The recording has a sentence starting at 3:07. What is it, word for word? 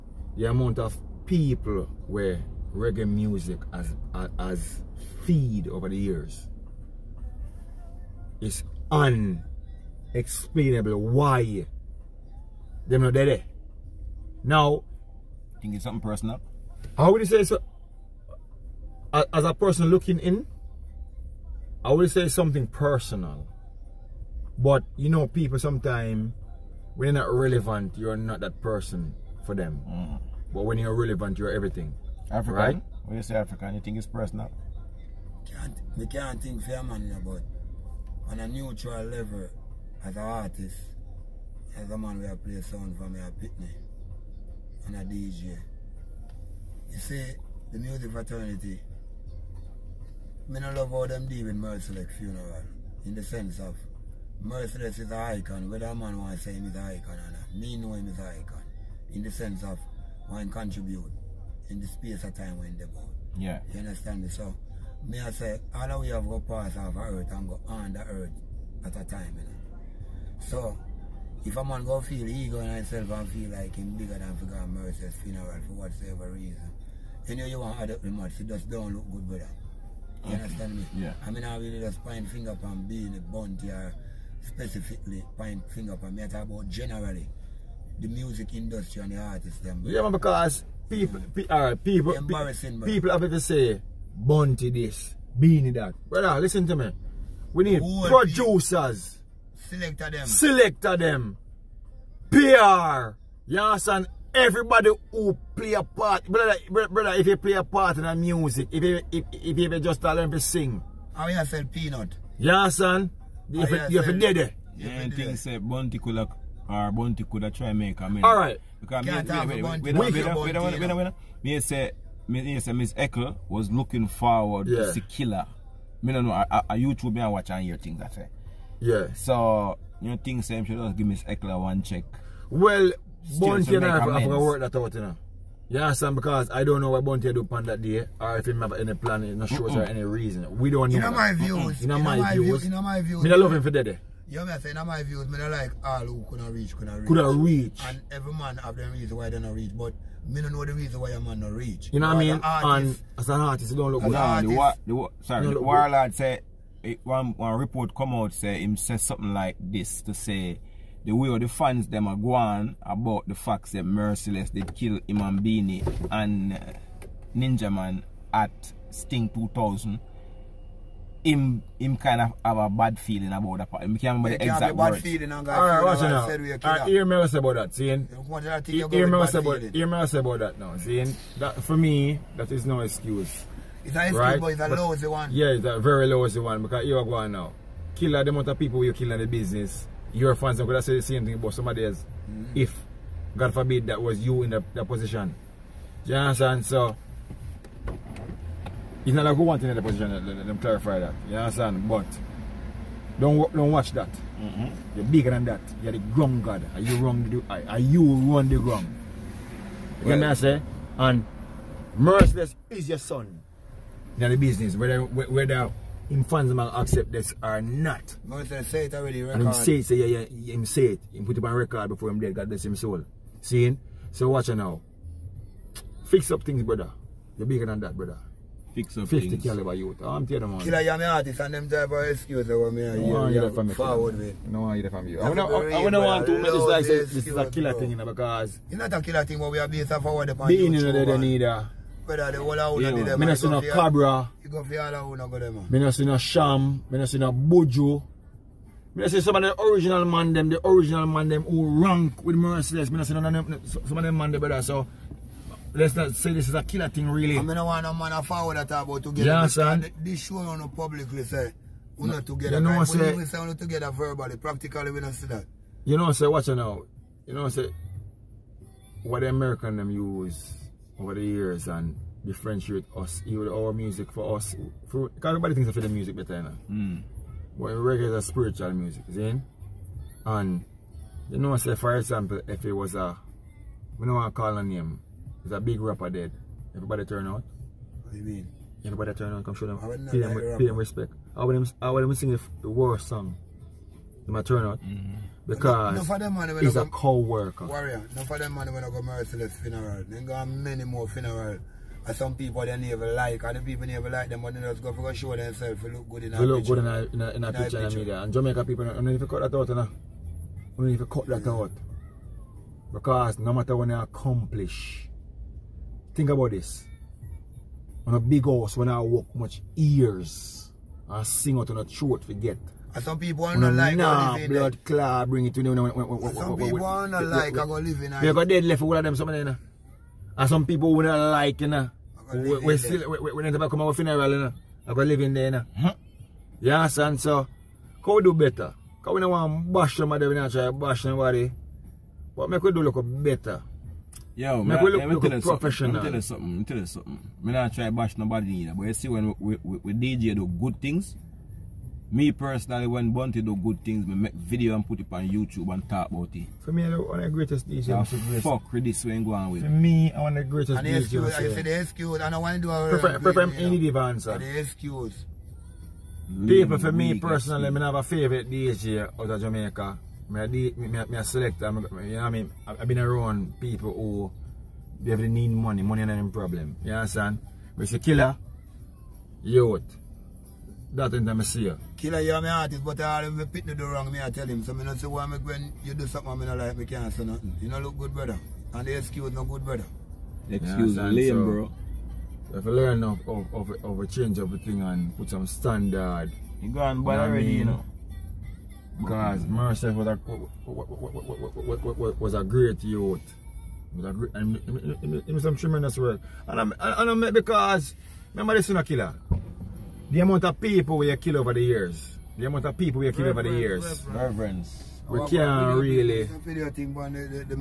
Kill the amount of people you kill in the business your fans gonna say the same thing about somebody else.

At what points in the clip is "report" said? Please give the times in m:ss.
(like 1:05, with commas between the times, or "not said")
2:37.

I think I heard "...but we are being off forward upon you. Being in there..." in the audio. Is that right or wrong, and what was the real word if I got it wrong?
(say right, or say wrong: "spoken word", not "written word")
right.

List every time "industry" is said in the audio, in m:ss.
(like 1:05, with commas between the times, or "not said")
1:28.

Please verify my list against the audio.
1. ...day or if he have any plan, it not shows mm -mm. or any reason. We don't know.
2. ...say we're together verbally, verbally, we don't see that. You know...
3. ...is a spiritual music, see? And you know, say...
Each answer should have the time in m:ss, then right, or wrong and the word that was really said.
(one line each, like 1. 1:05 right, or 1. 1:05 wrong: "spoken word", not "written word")
1. 2:17 right
2. 4:23 wrong: "practically", not "verbally"
3. 4:38 right.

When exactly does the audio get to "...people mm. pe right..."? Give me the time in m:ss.
1:30.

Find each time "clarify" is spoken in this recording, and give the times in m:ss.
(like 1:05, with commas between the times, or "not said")
3:20.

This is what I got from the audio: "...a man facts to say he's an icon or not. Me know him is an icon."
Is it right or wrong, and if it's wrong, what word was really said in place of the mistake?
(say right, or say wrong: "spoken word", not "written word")
wrong: "wants", not "facts".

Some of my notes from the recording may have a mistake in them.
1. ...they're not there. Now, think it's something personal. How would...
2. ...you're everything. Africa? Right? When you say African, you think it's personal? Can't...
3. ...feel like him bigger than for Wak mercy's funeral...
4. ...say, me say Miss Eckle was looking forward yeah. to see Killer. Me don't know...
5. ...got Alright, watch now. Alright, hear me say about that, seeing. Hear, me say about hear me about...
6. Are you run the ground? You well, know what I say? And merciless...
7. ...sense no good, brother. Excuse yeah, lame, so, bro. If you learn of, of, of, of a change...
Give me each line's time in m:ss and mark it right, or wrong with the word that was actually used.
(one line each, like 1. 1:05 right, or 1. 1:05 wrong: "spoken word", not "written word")
1. 0:12 right
2. 0:31 right
3. 1:13 wrong: "God", not "Wak"
4. 2:01 right
5. 2:55 right
6. 3:27 right
7. 6:28 wrong: "excuse", not "sense".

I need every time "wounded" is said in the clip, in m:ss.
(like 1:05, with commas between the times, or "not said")
not said.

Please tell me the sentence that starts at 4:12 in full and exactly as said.
Me see none of them, some of them man them, brother.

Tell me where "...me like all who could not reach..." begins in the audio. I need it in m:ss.
2:25.